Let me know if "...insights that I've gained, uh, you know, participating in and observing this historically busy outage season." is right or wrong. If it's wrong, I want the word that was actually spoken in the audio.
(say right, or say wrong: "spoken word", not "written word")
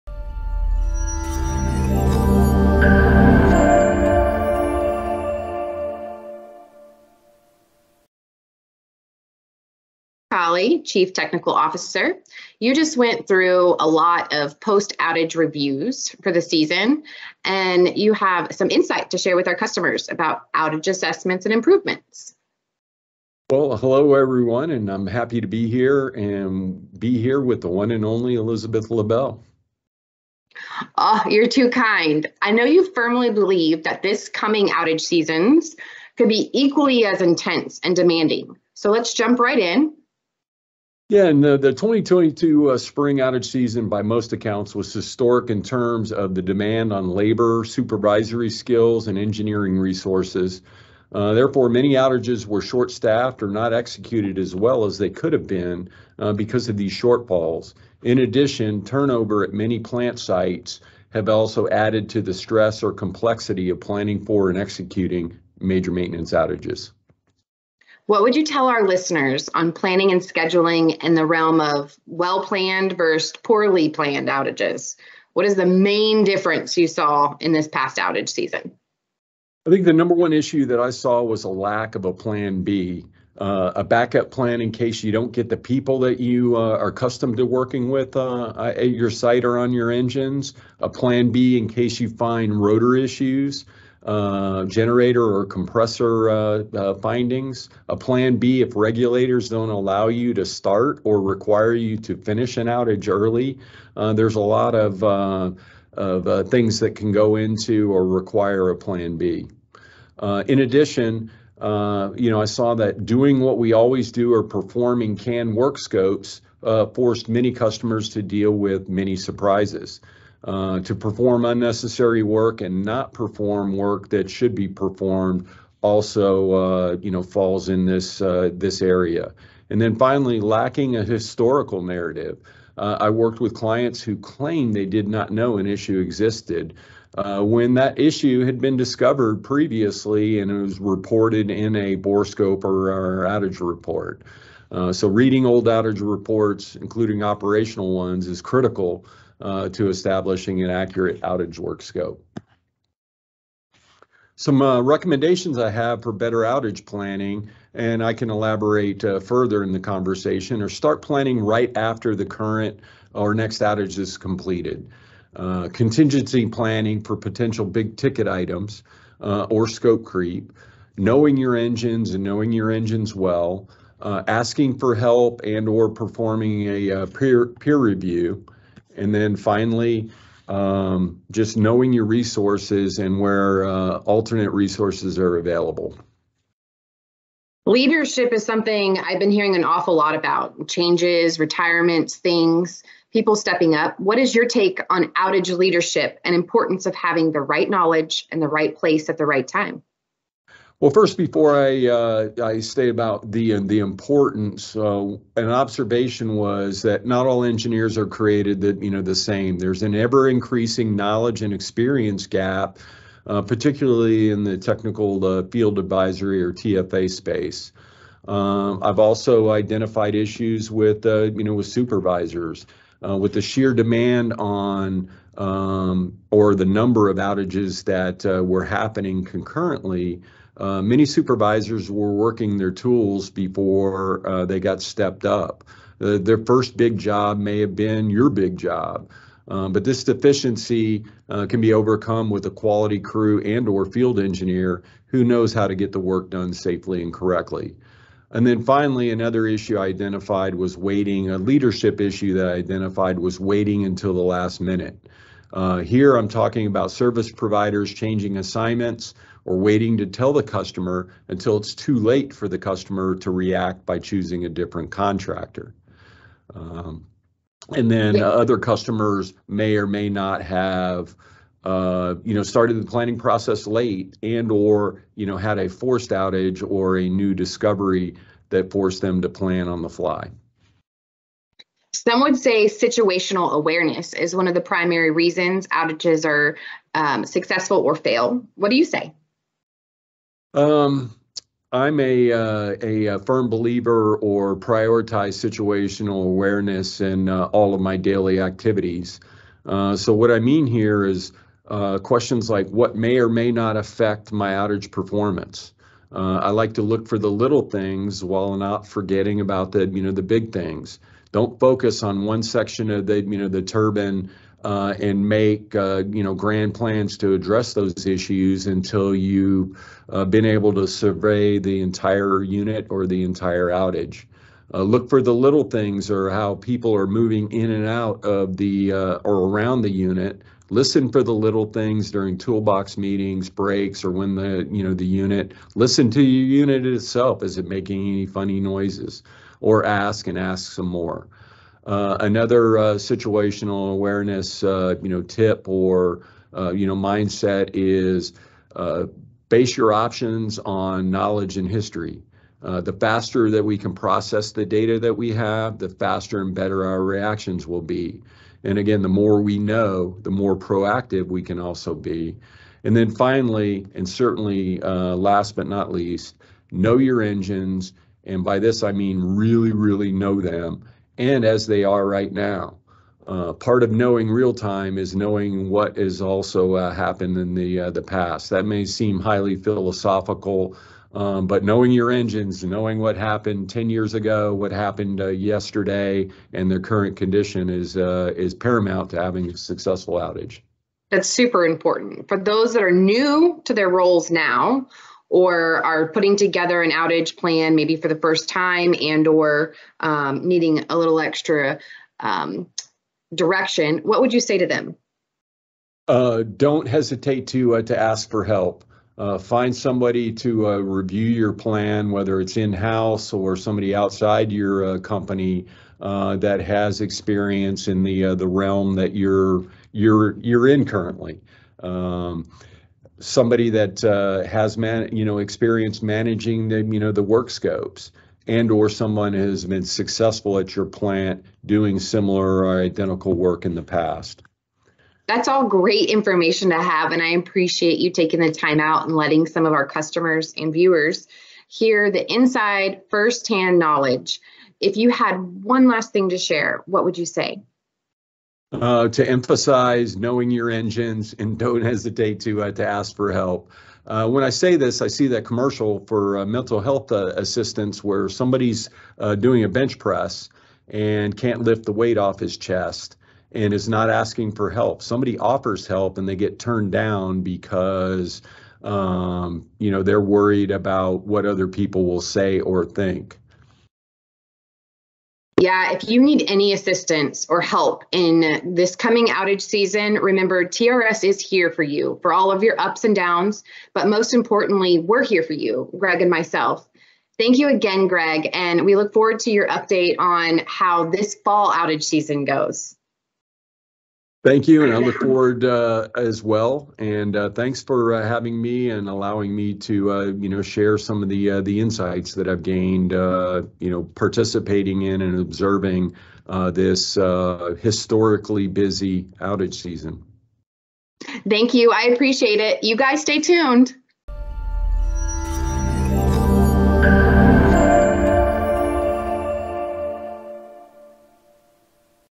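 right.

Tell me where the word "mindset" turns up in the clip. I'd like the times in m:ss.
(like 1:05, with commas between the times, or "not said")
5:46.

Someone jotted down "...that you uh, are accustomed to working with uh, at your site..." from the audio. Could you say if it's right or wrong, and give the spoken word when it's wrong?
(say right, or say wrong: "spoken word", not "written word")
right.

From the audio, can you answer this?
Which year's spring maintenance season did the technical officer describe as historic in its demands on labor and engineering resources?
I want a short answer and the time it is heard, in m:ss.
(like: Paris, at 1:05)
2022, at 0:41.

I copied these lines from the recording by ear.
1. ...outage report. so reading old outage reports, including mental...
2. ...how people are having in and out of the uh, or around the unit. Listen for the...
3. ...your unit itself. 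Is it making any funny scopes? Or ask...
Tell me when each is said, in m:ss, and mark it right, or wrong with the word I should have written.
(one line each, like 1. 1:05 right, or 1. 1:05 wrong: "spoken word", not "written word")
1. 2:23 wrong: "operational", not "mental"
2. 5:26 wrong: "moving", not "having"
3. 5:36 wrong: "noises", not "scopes".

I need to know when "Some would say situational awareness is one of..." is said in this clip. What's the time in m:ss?
4:41.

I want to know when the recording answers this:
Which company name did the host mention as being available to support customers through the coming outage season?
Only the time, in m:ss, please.
8:00.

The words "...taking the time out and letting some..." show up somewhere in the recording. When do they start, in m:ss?
7:18.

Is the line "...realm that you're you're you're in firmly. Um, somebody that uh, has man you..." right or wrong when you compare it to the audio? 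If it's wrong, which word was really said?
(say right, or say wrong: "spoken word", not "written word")
wrong: "currently", not "firmly".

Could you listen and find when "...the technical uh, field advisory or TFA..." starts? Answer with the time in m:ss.
3:34.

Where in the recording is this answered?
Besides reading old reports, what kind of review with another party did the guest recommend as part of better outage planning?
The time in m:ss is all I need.
2:57.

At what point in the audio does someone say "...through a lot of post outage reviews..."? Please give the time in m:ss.
0:13.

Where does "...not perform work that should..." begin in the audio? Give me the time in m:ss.
2:02.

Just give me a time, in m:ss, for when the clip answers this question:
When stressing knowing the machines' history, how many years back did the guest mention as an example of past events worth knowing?
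6:23.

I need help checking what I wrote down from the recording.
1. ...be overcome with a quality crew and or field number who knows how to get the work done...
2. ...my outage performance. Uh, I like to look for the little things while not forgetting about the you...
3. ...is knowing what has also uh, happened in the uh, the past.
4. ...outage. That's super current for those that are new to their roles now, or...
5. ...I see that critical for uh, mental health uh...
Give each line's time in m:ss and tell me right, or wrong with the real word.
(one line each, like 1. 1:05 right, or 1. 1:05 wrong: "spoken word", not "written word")
1. 4:01 wrong: "engineer", not "number"
2. 5:04 right
3. 6:14 right
4. 6:30 wrong: "important", not "current"
5. 7:35 wrong: "commercial", not "critical".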